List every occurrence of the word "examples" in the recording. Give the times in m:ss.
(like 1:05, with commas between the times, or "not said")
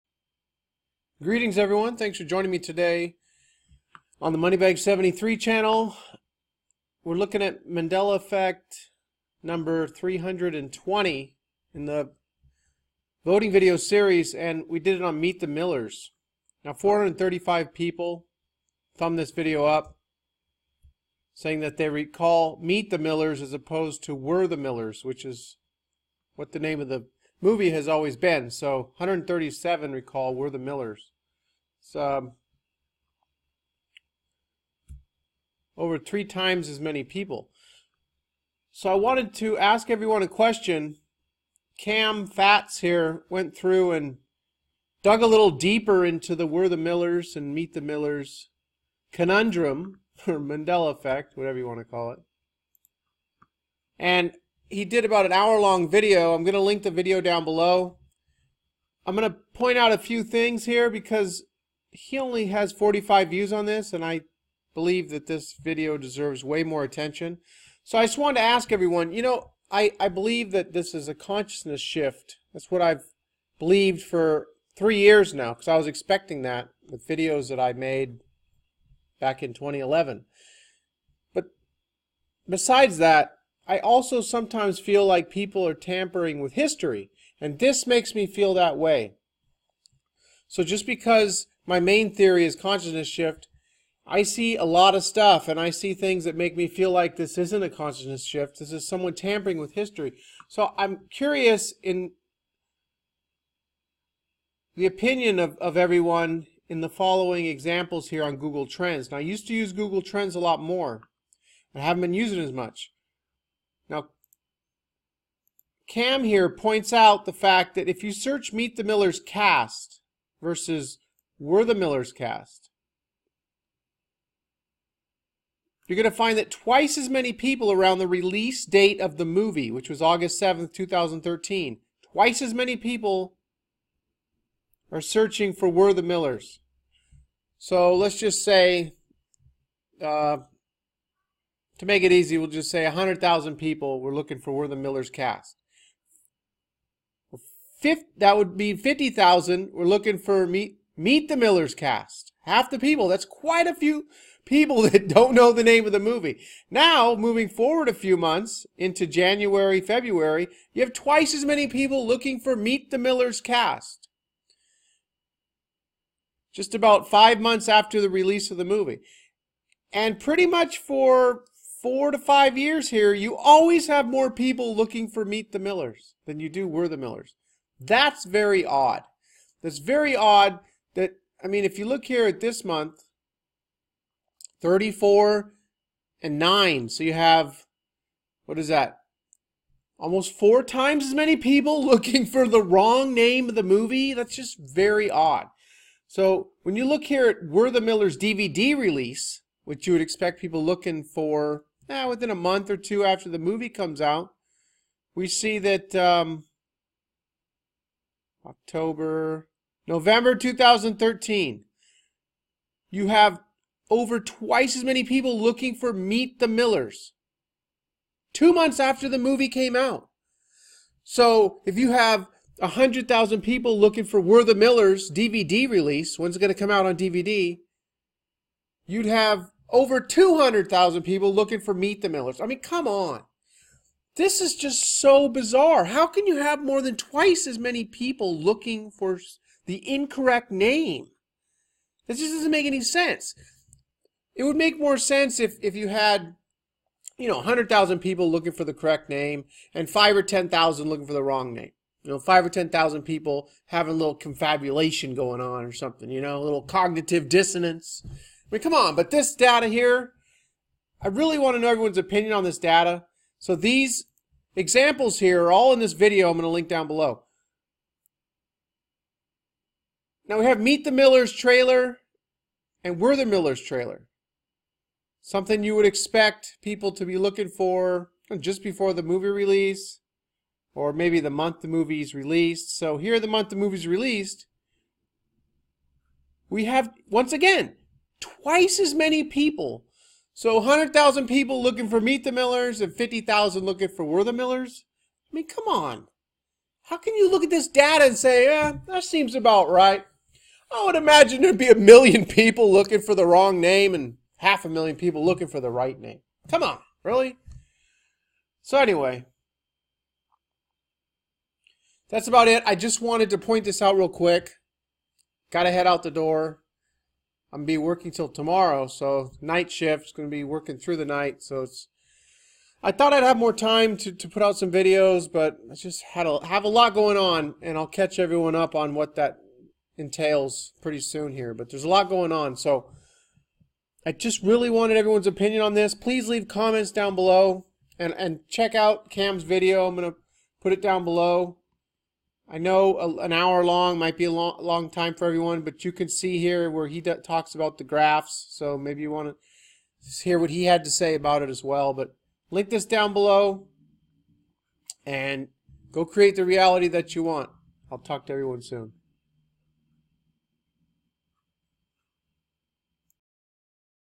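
1:47, 4:24.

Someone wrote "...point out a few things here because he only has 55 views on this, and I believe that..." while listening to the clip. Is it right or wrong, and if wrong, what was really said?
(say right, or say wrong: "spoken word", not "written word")
wrong: "45", not "55".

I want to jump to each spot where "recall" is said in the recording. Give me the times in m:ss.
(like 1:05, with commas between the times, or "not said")
0:21, 0:29.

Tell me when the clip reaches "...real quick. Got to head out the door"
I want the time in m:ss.
5:13.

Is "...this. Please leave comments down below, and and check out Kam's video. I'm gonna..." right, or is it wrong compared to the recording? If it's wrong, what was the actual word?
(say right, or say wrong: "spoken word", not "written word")
right.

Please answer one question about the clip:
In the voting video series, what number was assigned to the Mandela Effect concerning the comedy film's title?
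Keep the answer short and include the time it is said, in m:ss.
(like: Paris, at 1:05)
320, at 0:09.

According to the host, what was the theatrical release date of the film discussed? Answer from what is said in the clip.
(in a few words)
August 7th, 2013.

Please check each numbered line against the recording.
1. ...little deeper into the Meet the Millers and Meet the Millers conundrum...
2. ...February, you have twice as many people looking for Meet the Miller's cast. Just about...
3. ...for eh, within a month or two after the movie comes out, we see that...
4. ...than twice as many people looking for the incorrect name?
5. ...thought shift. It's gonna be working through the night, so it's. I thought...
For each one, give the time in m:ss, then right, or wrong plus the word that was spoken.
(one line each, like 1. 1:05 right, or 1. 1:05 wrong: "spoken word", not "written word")
1. 0:45 wrong: "Were", not "Meet"
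2. 2:39 right
3. 3:21 right
4. 3:56 right
5. 5:19 wrong: "night", not "thought".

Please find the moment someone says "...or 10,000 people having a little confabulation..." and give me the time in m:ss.
4:12.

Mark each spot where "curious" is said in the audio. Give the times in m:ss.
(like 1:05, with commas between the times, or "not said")
1:41.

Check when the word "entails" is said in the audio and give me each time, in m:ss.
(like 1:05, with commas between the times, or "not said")
5:29.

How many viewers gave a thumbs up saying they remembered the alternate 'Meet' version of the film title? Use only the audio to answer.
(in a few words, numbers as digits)
435.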